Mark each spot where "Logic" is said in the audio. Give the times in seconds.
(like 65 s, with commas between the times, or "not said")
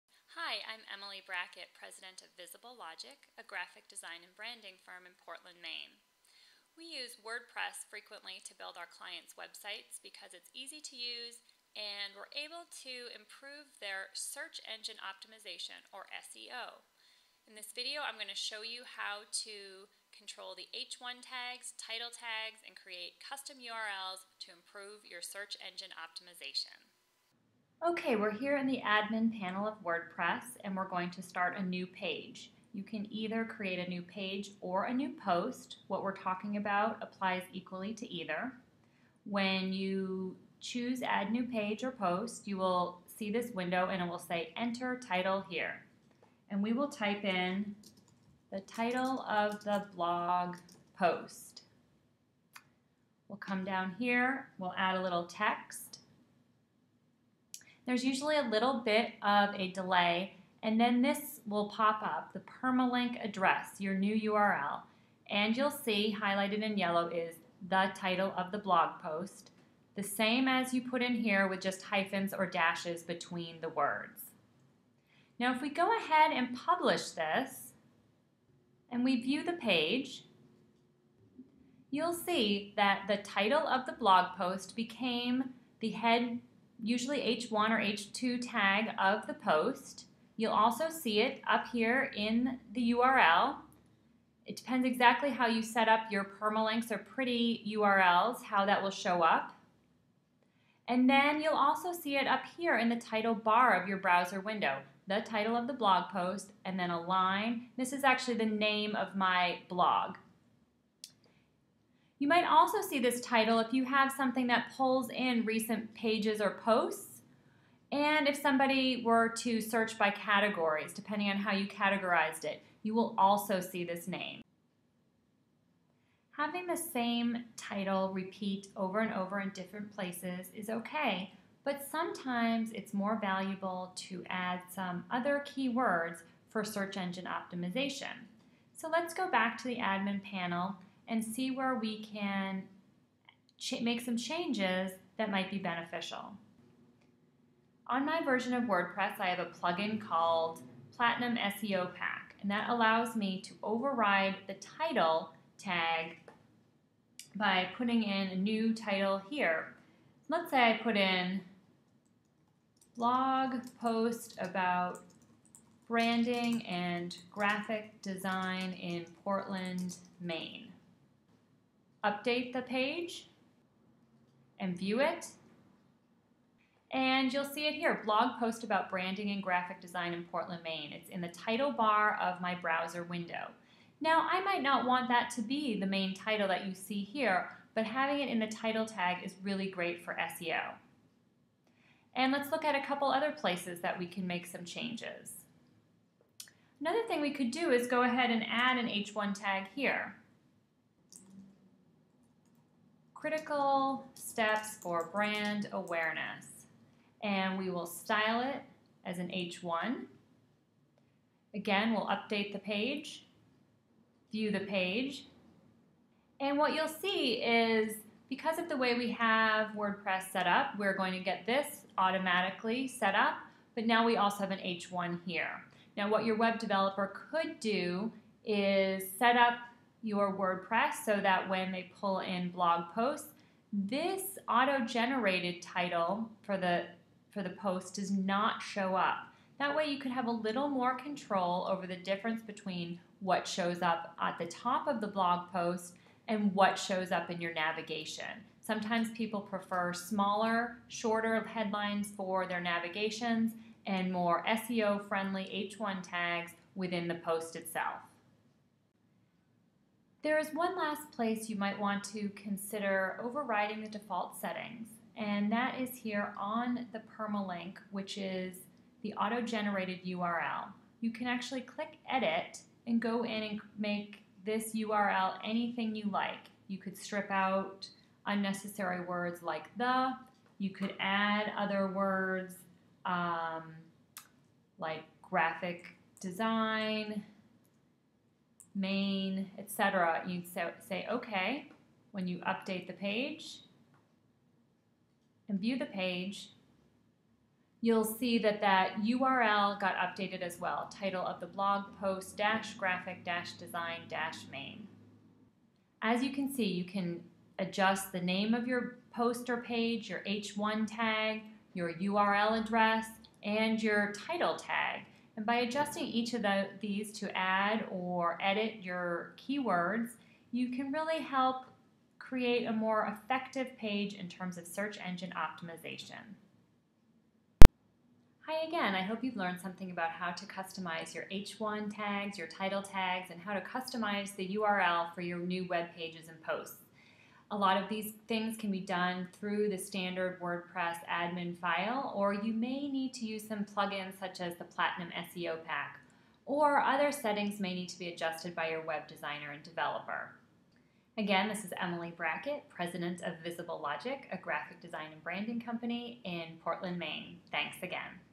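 2 s, 353 s.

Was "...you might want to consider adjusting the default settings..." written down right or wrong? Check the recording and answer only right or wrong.
wrong.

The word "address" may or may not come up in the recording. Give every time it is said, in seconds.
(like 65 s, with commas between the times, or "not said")
63 s, 312 s.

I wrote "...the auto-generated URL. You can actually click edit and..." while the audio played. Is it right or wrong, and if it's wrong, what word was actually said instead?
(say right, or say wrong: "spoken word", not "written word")
right.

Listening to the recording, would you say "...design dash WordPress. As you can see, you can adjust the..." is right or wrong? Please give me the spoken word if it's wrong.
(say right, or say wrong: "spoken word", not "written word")
wrong: "Maine", not "WordPress".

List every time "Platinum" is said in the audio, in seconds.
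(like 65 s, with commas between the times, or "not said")
150 s, 344 s.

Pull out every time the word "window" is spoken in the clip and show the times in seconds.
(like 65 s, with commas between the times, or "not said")
43 s, 104 s, 183 s.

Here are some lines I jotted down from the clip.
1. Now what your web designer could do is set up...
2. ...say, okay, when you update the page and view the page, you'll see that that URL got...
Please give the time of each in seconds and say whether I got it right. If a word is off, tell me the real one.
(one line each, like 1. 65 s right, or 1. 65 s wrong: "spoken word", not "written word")
1. 225 s wrong: "developer", not "designer"
2. 290 s right.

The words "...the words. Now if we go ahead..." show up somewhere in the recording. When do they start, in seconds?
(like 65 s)
73 s.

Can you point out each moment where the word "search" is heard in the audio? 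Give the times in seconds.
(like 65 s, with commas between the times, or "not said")
14 s, 25 s, 119 s, 136 s, 324 s.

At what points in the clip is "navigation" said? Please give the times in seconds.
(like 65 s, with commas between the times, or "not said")
247 s, 252 s.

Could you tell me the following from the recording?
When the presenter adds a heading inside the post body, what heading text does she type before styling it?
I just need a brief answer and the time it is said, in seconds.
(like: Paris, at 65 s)
critical steps for brand awareness, at 203 s.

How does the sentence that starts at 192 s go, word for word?
And let's look at a couple other places that we can make some changes.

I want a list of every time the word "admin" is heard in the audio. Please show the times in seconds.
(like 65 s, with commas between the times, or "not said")
28 s, 139 s, 341 s.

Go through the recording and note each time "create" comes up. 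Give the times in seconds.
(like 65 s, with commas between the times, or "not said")
22 s, 33 s, 322 s.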